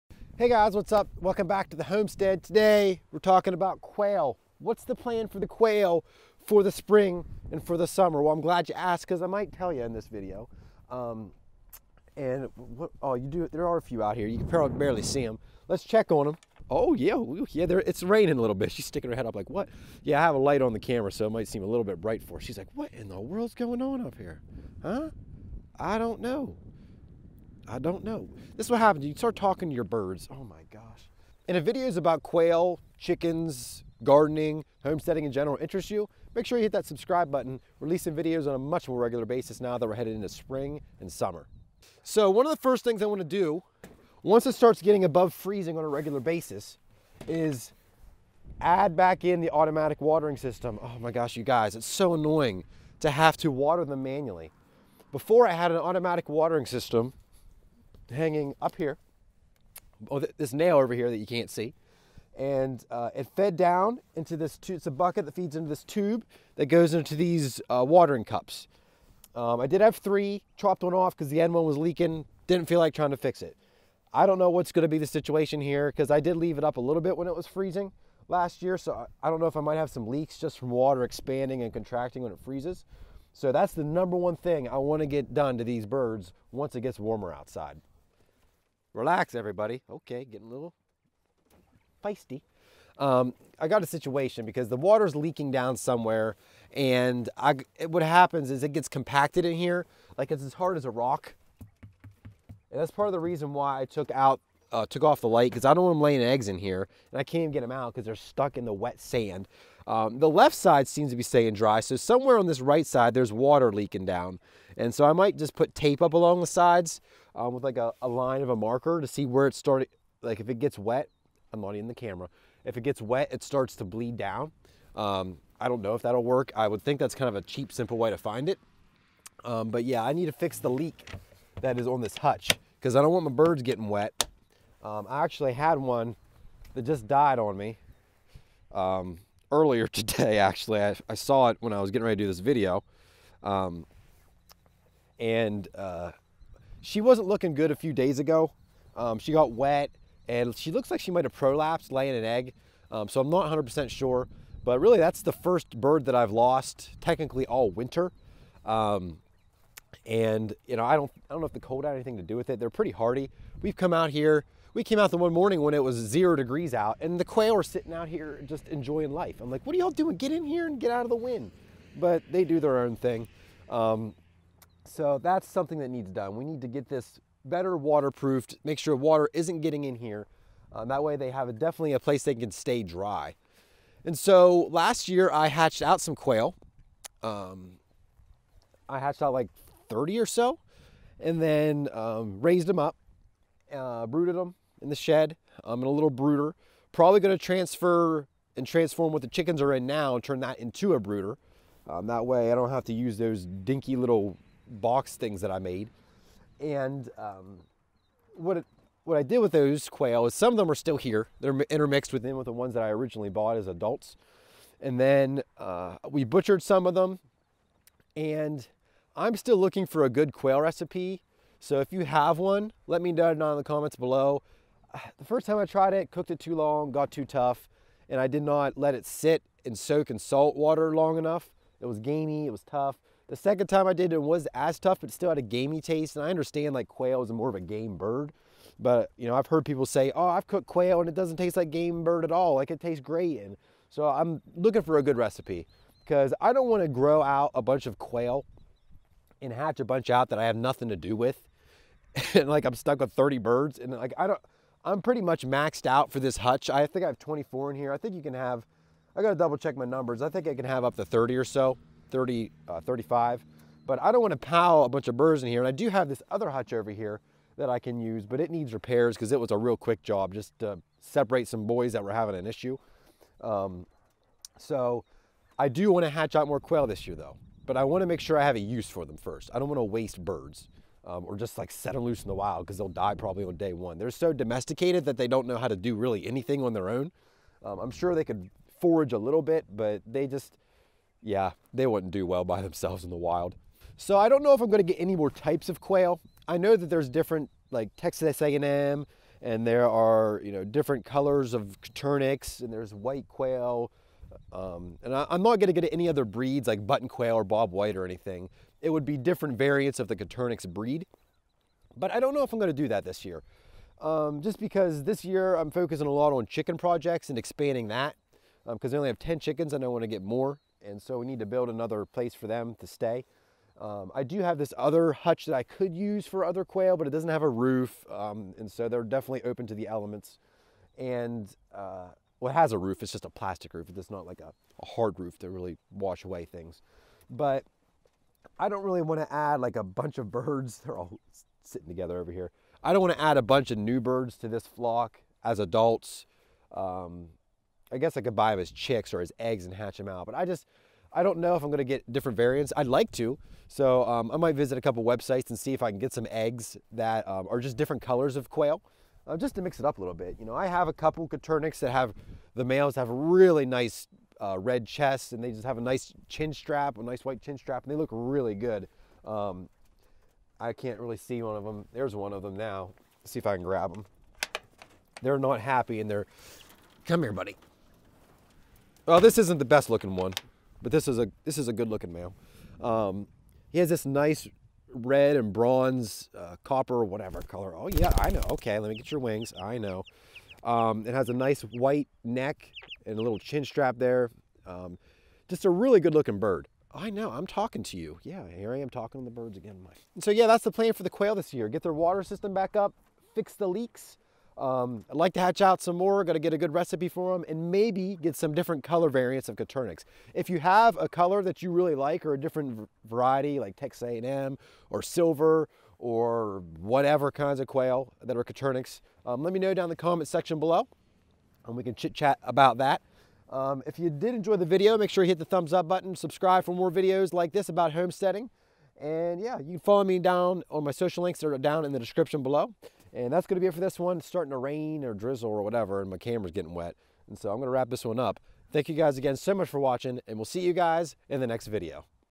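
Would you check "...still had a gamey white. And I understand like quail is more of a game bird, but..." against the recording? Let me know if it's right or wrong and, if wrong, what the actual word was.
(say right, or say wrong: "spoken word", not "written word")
wrong: "taste", not "white".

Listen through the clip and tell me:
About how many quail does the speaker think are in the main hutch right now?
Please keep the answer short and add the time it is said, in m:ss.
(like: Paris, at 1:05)
24, at 4:17.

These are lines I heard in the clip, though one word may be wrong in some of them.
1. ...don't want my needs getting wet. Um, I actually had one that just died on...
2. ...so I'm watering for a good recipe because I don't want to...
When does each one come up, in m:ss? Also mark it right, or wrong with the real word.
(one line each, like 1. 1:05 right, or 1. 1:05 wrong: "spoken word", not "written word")
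1. 2:13 wrong: "birds", not "needs"
2. 4:03 wrong: "looking", not "watering".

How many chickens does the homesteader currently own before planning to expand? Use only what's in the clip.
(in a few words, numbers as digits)
10.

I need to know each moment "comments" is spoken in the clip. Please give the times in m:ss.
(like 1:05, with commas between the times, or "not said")
3:43, 6:59.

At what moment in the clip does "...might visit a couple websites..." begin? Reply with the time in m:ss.
5:54.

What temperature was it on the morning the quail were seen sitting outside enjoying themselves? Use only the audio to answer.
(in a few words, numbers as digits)
0 degrees.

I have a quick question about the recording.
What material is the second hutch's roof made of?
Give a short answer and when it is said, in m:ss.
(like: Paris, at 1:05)
plastic, at 5:33.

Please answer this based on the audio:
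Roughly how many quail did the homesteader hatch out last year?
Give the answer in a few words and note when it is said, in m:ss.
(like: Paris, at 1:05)
30, at 3:09.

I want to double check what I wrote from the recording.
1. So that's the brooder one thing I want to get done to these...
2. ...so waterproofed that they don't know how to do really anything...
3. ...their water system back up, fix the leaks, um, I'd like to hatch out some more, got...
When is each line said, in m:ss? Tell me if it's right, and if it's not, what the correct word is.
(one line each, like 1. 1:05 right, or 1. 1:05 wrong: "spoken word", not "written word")
1. 1:23 wrong: "number", not "brooder"
2. 4:44 wrong: "domesticated", not "waterproofed"
3. 6:41 right.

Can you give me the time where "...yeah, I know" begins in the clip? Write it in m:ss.
6:27.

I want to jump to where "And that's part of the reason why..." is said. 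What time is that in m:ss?
1:42.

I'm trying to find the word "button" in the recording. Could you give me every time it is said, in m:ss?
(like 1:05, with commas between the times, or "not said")
0:37, 5:06, 7:05.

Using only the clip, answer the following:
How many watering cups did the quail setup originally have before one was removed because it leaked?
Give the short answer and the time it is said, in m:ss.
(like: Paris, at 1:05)
3, at 1:09.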